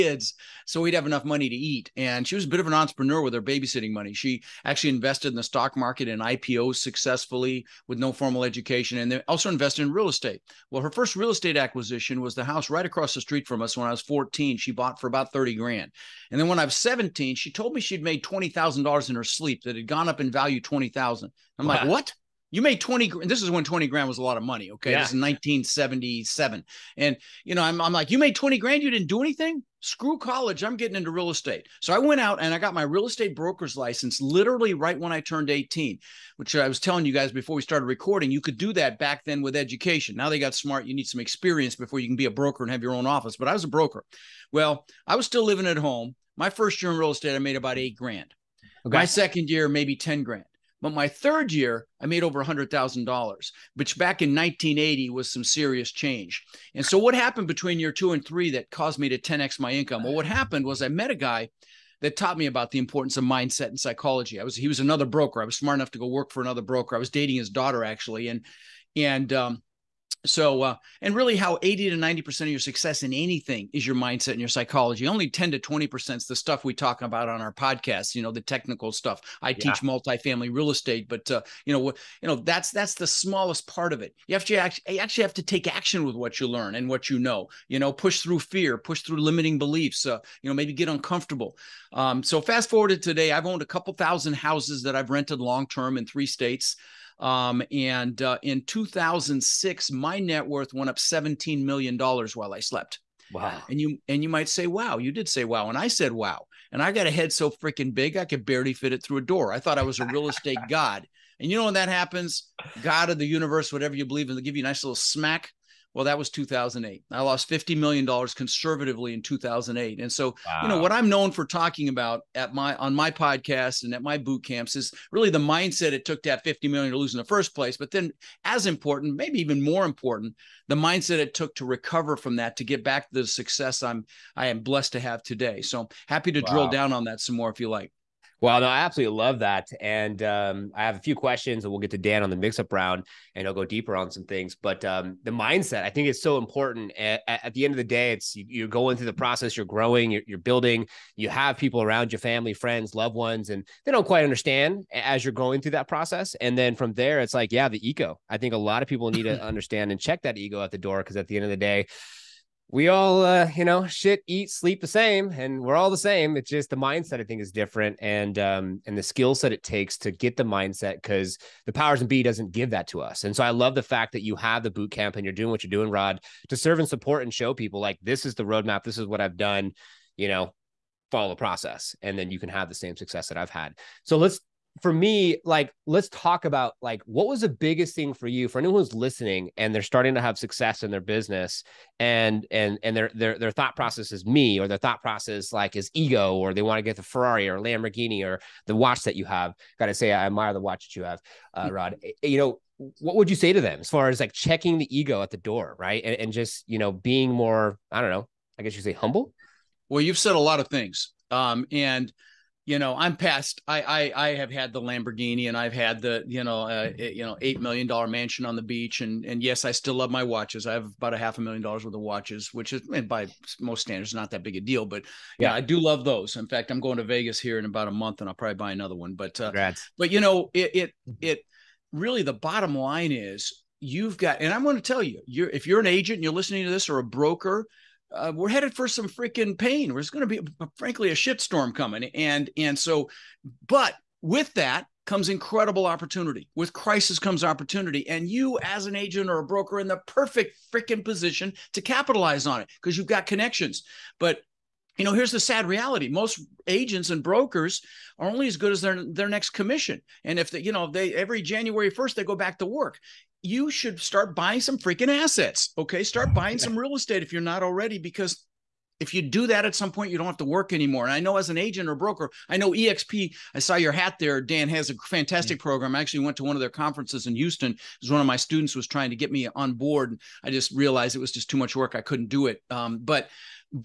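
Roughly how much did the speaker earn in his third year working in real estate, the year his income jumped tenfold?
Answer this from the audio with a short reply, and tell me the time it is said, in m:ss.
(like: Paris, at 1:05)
over $100,000, at 0:52.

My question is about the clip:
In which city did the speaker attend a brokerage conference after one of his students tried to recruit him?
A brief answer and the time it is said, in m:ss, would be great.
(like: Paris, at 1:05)
Houston, at 4:37.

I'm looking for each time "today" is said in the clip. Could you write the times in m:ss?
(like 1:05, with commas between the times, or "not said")
1:32, 2:15.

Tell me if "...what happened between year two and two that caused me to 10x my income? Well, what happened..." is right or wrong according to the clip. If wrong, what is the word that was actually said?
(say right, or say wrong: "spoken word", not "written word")
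wrong: "three", not "two".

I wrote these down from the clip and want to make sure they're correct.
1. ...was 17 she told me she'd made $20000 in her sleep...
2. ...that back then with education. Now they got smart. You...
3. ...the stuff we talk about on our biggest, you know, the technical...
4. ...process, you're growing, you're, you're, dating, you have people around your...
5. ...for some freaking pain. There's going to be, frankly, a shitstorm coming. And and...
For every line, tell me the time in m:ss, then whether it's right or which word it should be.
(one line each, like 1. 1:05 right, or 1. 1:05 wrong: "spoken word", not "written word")
1. 0:16 right
2. 0:38 right
3. 1:16 wrong: "podcast", not "biggest"
4. 2:29 wrong: "building", not "dating"
5. 3:58 right.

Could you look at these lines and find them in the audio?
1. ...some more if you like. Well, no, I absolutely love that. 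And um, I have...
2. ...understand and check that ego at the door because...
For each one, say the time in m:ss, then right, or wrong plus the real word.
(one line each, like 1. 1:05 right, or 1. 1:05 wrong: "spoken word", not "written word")
1. 2:17 right
2. 2:39 right.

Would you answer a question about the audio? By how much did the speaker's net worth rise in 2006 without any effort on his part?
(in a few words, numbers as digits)
$17 million.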